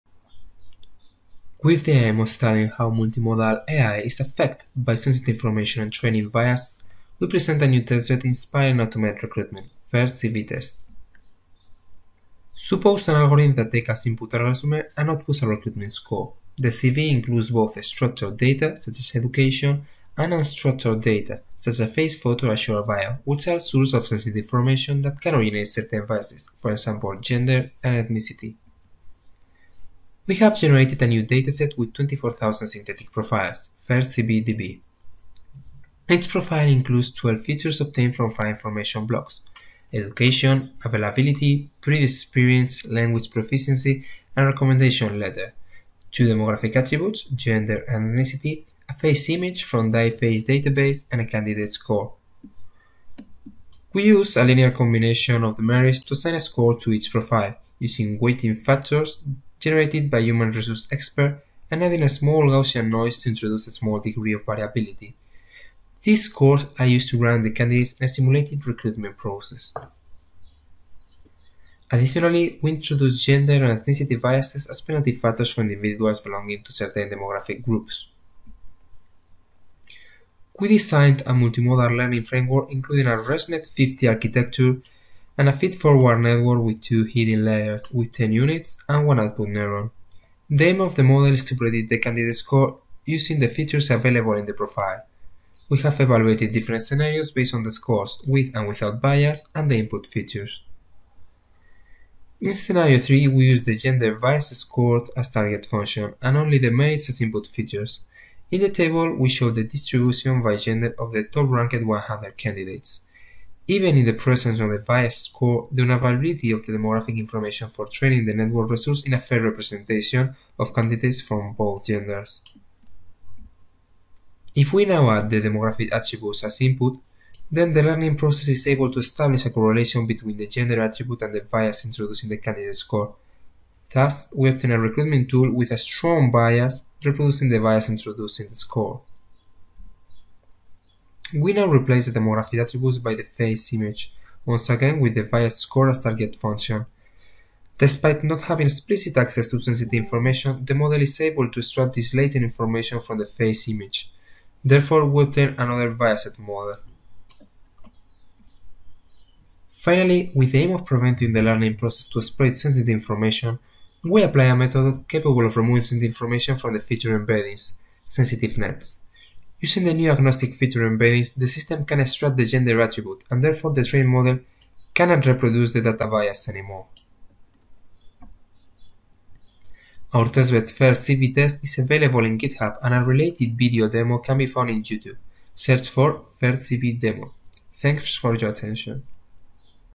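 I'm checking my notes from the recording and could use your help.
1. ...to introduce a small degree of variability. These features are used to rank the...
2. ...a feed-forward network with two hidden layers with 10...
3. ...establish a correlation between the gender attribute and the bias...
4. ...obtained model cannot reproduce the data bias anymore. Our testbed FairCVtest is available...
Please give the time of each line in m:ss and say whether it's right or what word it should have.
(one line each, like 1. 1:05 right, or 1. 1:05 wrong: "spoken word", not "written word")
1. 1:03 wrong: "scores", not "features"
2. 1:25 right
3. 2:08 right
4. 2:53 wrong: "trained", not "obtained".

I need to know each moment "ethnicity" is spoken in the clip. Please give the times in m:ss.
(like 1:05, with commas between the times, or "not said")
0:28, 0:48, 1:13.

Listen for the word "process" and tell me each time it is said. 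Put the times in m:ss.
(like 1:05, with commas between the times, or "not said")
1:09, 2:08, 2:41.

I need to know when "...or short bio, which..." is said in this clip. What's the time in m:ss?
0:22.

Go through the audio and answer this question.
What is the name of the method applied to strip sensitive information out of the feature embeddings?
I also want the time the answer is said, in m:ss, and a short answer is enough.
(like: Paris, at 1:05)
SensitiveNets, at 2:48.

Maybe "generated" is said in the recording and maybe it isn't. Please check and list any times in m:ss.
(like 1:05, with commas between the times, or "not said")
0:30, 0:59.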